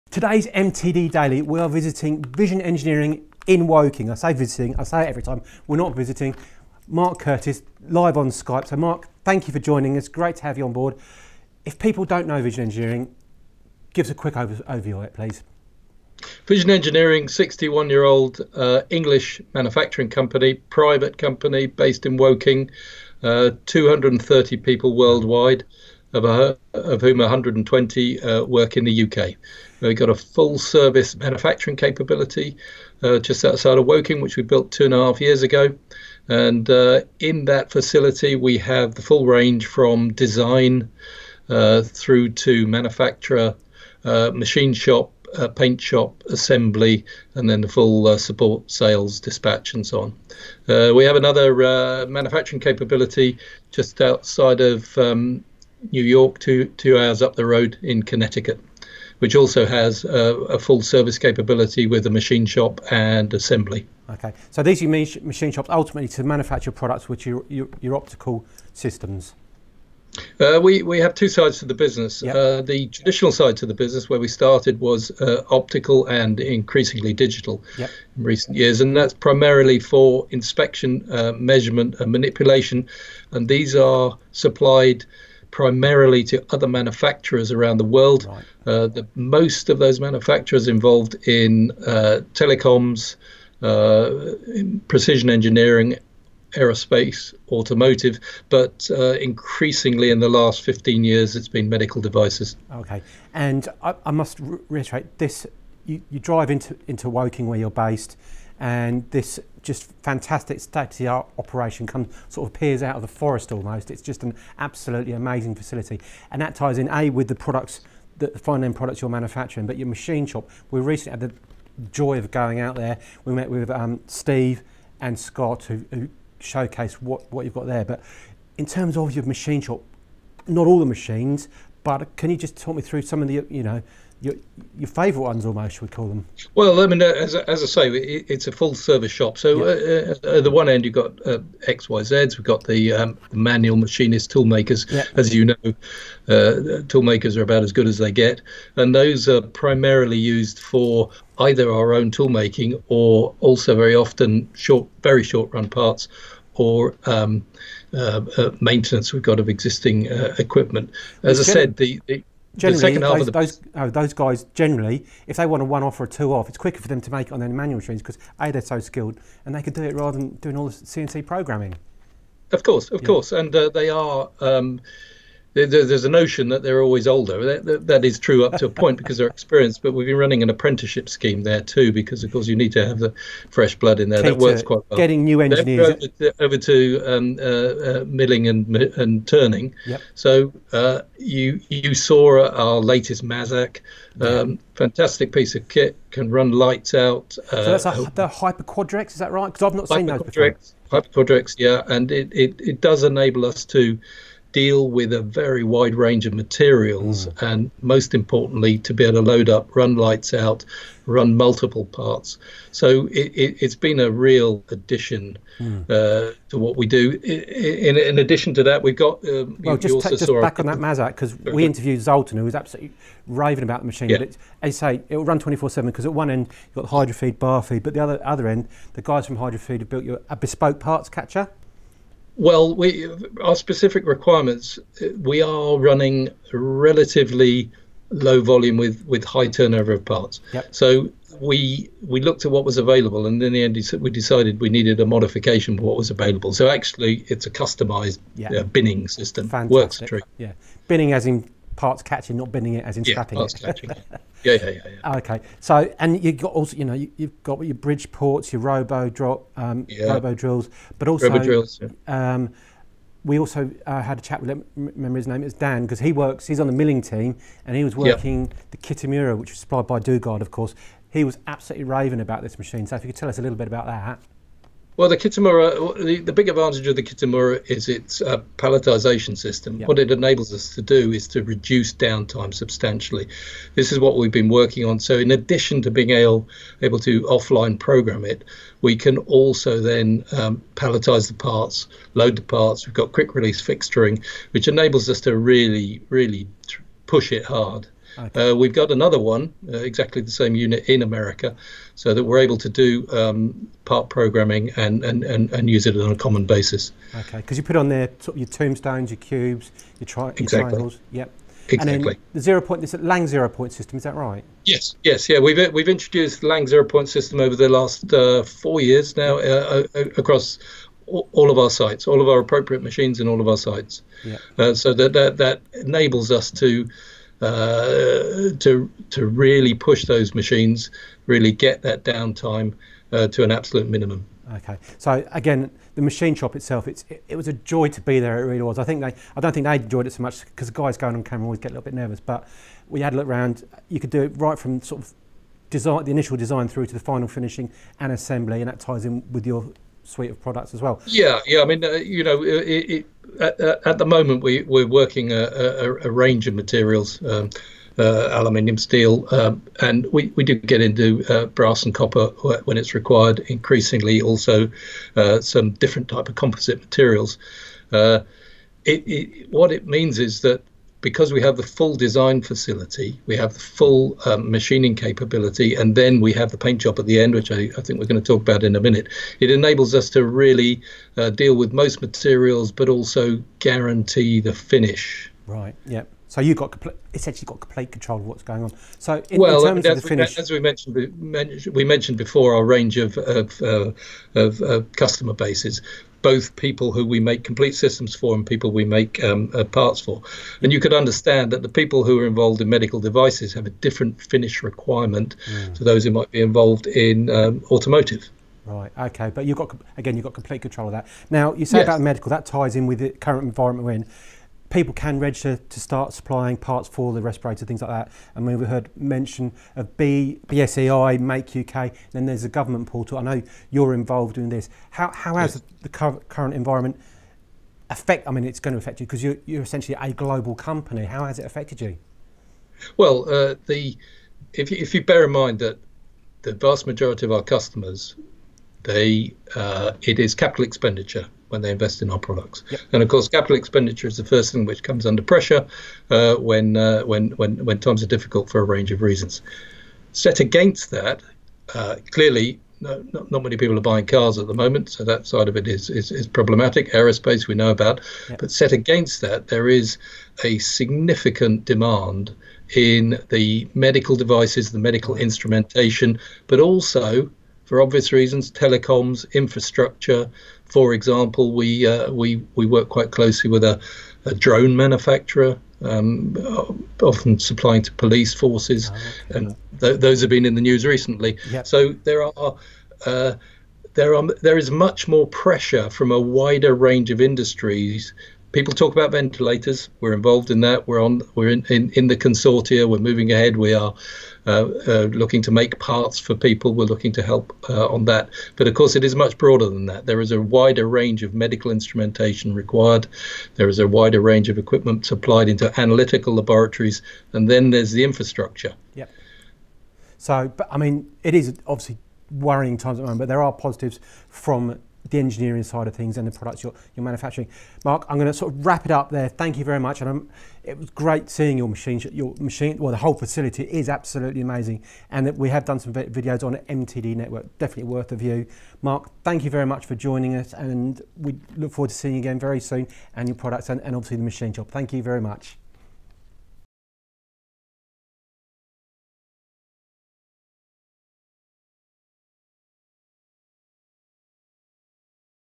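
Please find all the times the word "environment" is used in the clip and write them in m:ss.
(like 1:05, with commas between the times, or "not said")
6:53, 7:06.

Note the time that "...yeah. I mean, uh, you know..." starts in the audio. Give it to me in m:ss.
5:51.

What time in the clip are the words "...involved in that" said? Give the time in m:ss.
8:10.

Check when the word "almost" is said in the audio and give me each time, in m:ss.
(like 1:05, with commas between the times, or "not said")
1:53, 2:15.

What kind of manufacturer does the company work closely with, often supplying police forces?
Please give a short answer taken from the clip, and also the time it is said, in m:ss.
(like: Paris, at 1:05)
drone manufacturer, at 7:54.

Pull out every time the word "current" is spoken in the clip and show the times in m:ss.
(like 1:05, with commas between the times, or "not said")
6:53, 7:05.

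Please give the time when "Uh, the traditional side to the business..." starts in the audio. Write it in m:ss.
1:12.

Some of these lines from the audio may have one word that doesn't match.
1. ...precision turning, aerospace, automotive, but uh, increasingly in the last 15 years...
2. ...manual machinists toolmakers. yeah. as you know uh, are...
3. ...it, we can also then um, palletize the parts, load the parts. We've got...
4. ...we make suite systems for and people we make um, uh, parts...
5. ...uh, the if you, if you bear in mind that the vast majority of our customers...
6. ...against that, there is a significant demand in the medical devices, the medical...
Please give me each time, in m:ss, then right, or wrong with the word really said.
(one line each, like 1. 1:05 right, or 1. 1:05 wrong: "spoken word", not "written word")
1. 1:34 wrong: "engineering", not "turning"
2. 2:23 right
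3. 4:48 right
4. 6:37 wrong: "complete", not "suite"
5. 7:13 right
6. 7:38 right.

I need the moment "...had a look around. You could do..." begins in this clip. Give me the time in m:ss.
5:42.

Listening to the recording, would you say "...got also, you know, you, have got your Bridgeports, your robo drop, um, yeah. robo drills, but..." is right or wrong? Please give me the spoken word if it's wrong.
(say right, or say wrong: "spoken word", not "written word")
right.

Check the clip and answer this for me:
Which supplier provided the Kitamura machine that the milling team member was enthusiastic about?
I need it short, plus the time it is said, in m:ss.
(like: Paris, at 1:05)
Dugard, at 4:29.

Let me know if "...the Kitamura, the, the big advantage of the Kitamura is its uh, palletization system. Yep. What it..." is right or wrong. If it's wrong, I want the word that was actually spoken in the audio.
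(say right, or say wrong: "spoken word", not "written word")
right.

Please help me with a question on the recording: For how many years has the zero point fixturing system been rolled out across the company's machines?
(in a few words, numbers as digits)
4.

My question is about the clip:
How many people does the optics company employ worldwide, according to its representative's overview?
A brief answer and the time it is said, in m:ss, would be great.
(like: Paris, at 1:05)
230, at 0:23.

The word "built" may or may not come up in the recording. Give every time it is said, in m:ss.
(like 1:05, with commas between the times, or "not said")
0:34, 3:49.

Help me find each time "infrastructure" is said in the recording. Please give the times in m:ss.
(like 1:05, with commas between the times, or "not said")
7:49, 8:28.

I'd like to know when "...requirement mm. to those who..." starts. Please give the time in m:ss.
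6:44.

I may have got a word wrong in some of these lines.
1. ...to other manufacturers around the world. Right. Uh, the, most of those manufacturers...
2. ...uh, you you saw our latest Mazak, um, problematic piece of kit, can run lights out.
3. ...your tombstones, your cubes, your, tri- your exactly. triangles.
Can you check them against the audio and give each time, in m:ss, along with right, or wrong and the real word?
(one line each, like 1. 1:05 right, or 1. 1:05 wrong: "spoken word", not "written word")
1. 1:26 right
2. 3:10 wrong: "fantastic", not "problematic"
3. 5:08 right.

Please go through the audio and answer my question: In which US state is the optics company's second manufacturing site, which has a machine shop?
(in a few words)
Connecticut.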